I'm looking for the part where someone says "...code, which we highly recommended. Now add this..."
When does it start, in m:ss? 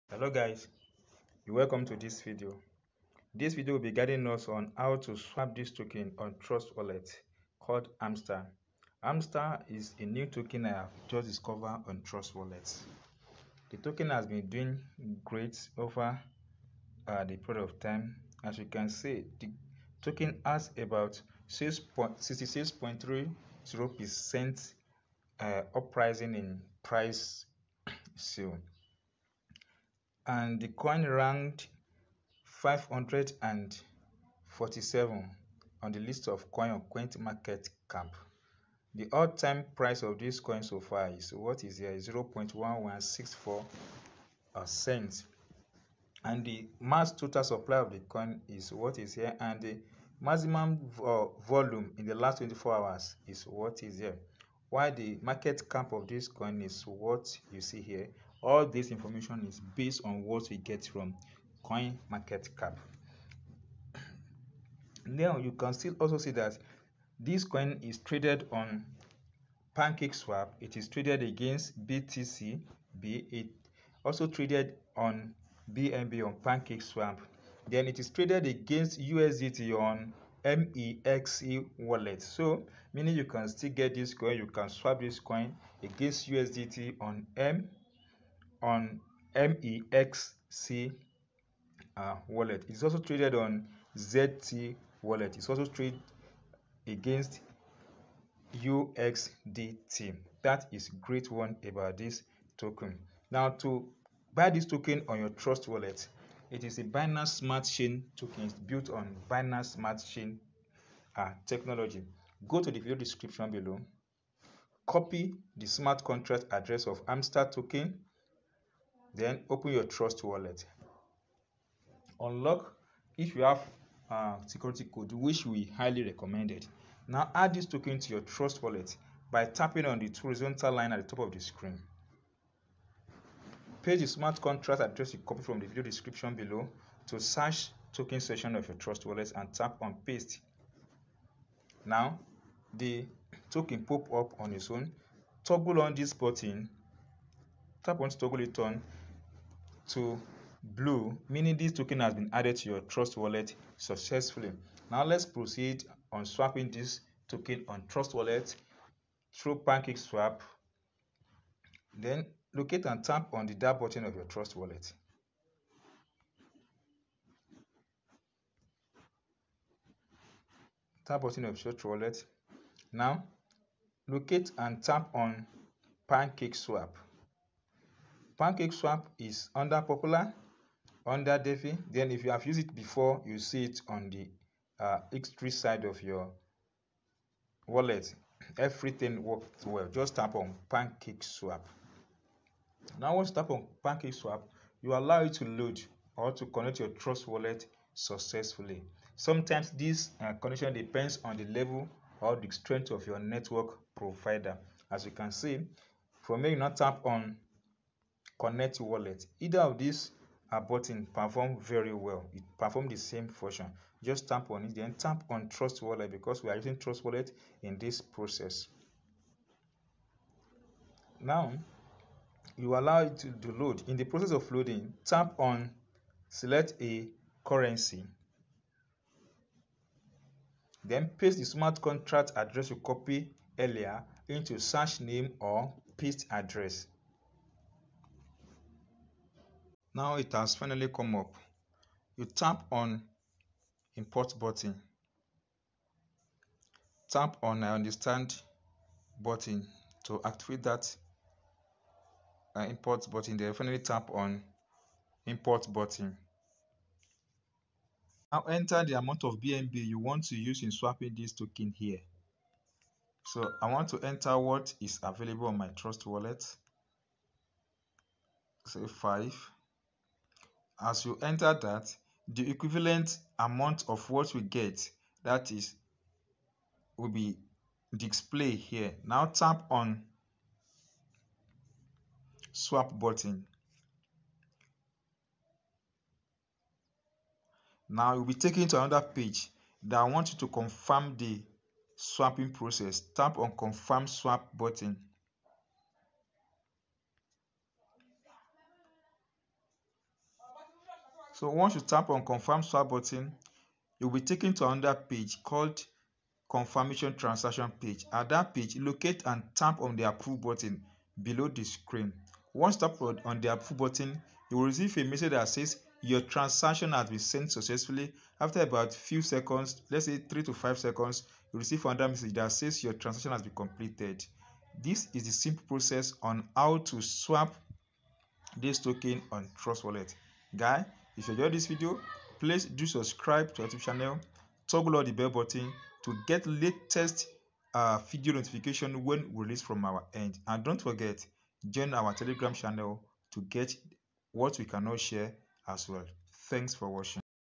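2:04.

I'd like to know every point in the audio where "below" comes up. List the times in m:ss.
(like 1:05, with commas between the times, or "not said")
1:53, 2:16, 5:11.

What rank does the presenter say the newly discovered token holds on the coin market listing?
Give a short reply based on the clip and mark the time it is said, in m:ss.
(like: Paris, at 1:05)
547, at 0:32.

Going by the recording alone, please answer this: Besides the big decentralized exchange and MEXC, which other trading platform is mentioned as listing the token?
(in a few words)
ZT.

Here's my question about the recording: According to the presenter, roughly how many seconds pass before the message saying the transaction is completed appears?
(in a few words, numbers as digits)
3 to 5 seconds.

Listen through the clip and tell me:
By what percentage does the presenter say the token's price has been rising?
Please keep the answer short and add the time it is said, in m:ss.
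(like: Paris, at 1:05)
66.30 percent, at 0:21.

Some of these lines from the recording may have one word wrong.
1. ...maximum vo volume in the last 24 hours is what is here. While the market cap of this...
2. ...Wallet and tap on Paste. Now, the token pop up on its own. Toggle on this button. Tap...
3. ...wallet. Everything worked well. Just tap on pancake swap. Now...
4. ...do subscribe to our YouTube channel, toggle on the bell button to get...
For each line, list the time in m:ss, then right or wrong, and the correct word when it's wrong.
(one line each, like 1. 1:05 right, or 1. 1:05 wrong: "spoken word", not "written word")
1. 0:50 right
2. 2:19 right
3. 3:07 right
4. 5:32 right.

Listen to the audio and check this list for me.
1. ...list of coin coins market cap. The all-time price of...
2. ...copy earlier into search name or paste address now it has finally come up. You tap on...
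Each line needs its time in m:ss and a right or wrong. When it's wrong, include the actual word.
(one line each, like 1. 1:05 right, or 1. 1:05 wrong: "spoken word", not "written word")
1. 0:35 right
2. 3:52 right.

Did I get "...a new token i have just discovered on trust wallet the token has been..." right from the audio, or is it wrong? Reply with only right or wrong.
right.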